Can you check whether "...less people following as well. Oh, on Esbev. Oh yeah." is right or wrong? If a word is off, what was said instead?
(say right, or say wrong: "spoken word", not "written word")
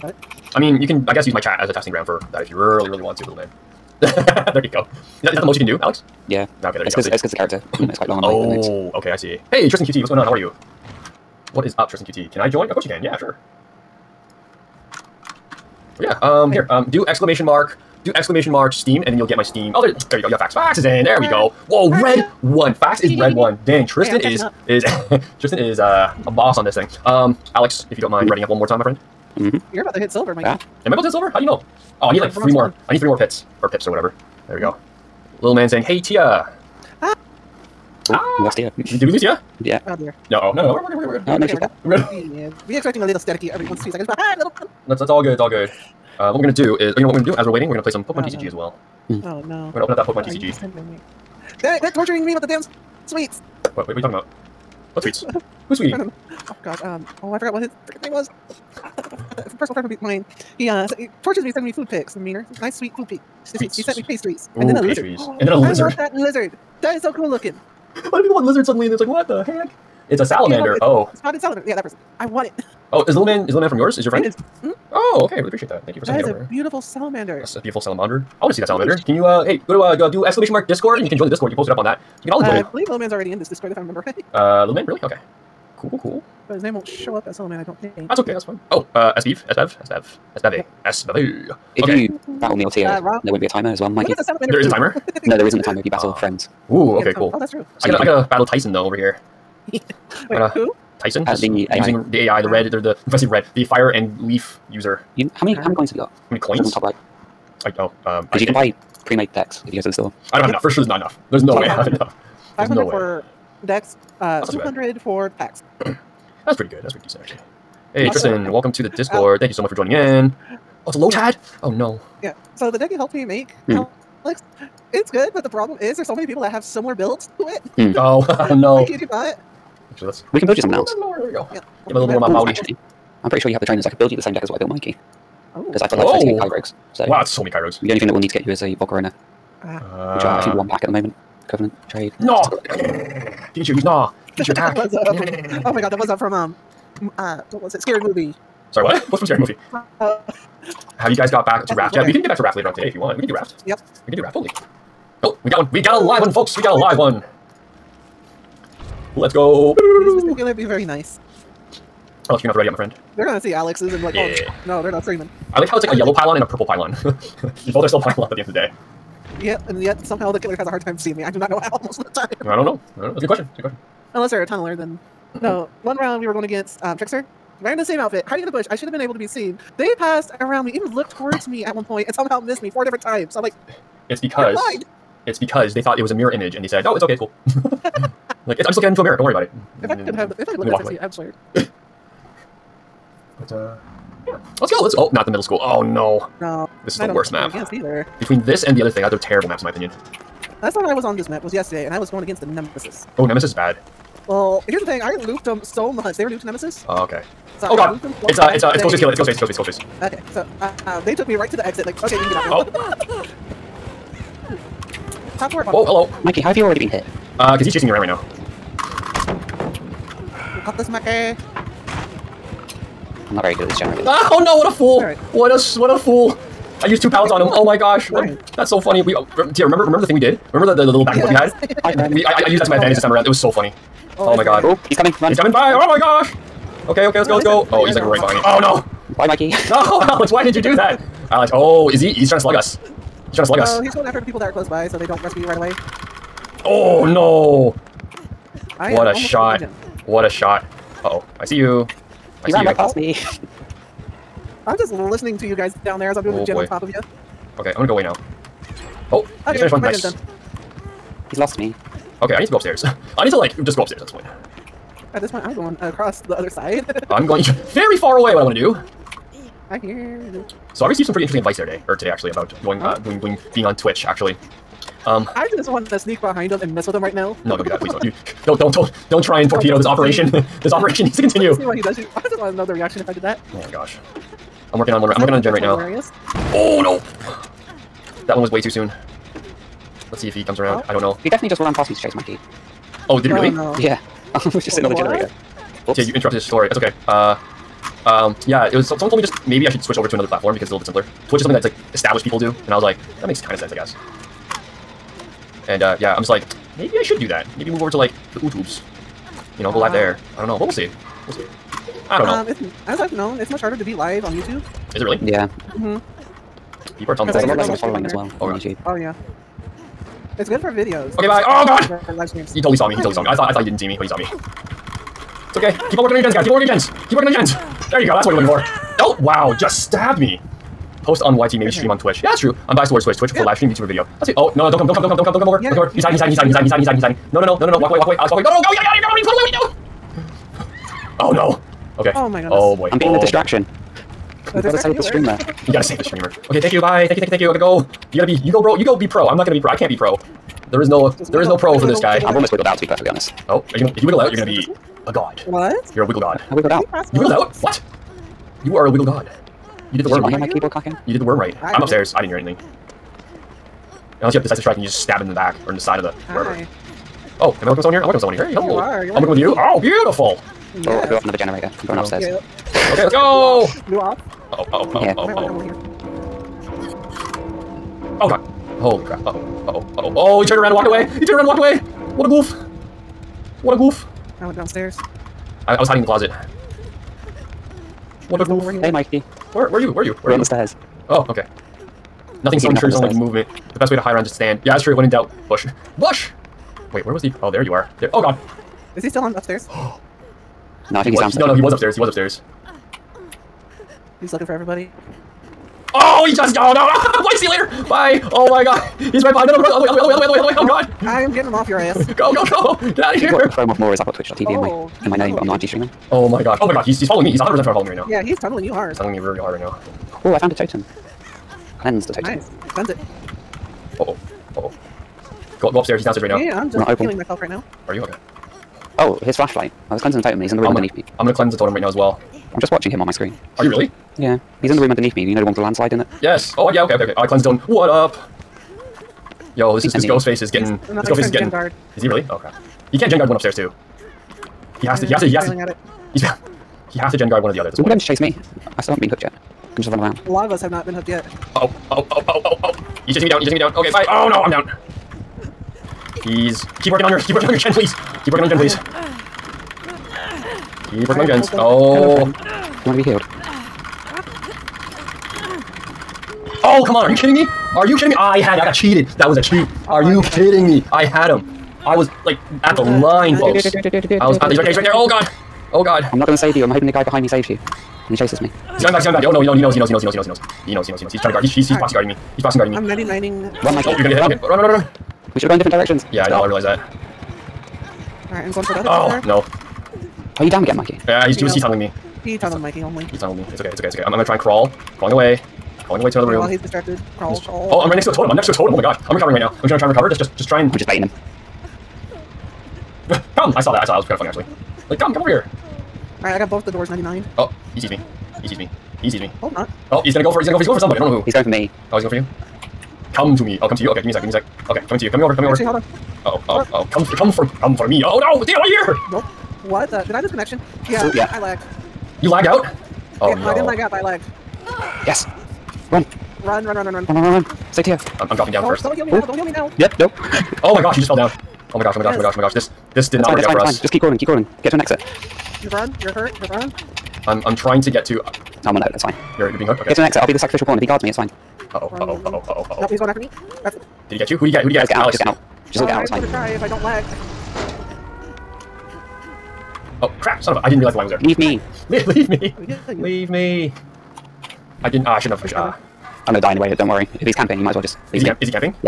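wrong: "YouTube", not "Esbev".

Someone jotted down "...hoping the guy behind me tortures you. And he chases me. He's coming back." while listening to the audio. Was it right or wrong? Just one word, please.
wrong.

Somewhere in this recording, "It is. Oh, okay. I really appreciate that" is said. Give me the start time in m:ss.
1:14.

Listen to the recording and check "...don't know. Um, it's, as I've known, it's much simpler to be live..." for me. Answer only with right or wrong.
wrong.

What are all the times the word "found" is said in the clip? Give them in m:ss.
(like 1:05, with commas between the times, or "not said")
7:00.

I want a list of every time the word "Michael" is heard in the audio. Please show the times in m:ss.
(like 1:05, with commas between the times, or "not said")
8:03.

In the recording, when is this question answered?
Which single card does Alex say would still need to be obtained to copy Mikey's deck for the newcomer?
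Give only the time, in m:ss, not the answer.
2:18.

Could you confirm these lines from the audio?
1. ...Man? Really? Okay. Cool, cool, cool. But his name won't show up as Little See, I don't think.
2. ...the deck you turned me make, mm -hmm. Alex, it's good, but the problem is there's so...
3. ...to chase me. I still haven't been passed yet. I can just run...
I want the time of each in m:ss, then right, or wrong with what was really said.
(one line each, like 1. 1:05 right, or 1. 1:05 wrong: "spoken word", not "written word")
1. 1:24 wrong: "Man", not "See"
2. 2:02 wrong: "helped", not "turned"
3. 7:27 wrong: "hooked", not "passed".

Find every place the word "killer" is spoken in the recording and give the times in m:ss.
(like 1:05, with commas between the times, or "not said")
2:40, 2:50, 3:28.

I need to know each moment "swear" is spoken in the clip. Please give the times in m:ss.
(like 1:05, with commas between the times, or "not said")
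3:11.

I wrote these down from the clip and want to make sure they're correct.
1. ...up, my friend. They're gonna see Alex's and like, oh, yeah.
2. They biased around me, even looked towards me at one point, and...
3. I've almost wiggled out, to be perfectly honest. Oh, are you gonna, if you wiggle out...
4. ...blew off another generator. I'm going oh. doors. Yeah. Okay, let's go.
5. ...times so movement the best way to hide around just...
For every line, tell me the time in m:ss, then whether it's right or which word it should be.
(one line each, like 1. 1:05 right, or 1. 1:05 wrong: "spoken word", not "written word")
1. 2:42 right
2. 2:59 wrong: "passed", not "biased"
3. 5:52 right
4. 6:11 wrong: "upstairs", not "doors"
5. 6:32 wrong: "ensures", not "times".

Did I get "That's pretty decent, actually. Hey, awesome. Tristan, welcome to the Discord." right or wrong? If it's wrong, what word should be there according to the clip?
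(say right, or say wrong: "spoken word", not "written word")
right.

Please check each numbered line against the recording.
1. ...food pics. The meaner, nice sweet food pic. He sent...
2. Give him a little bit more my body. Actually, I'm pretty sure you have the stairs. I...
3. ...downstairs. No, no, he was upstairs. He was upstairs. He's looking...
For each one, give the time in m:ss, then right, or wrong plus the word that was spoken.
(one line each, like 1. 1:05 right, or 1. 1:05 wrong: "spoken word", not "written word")
1. 1:01 right
2. 2:11 wrong: "trainers", not "stairs"
3. 6:41 right.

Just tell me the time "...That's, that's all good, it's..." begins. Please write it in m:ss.
0:44.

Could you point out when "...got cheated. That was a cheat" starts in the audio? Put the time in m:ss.
7:48.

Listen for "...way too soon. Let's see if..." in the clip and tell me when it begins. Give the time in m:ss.
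4:48.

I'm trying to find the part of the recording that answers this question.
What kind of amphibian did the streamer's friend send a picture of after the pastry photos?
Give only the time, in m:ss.
1:11.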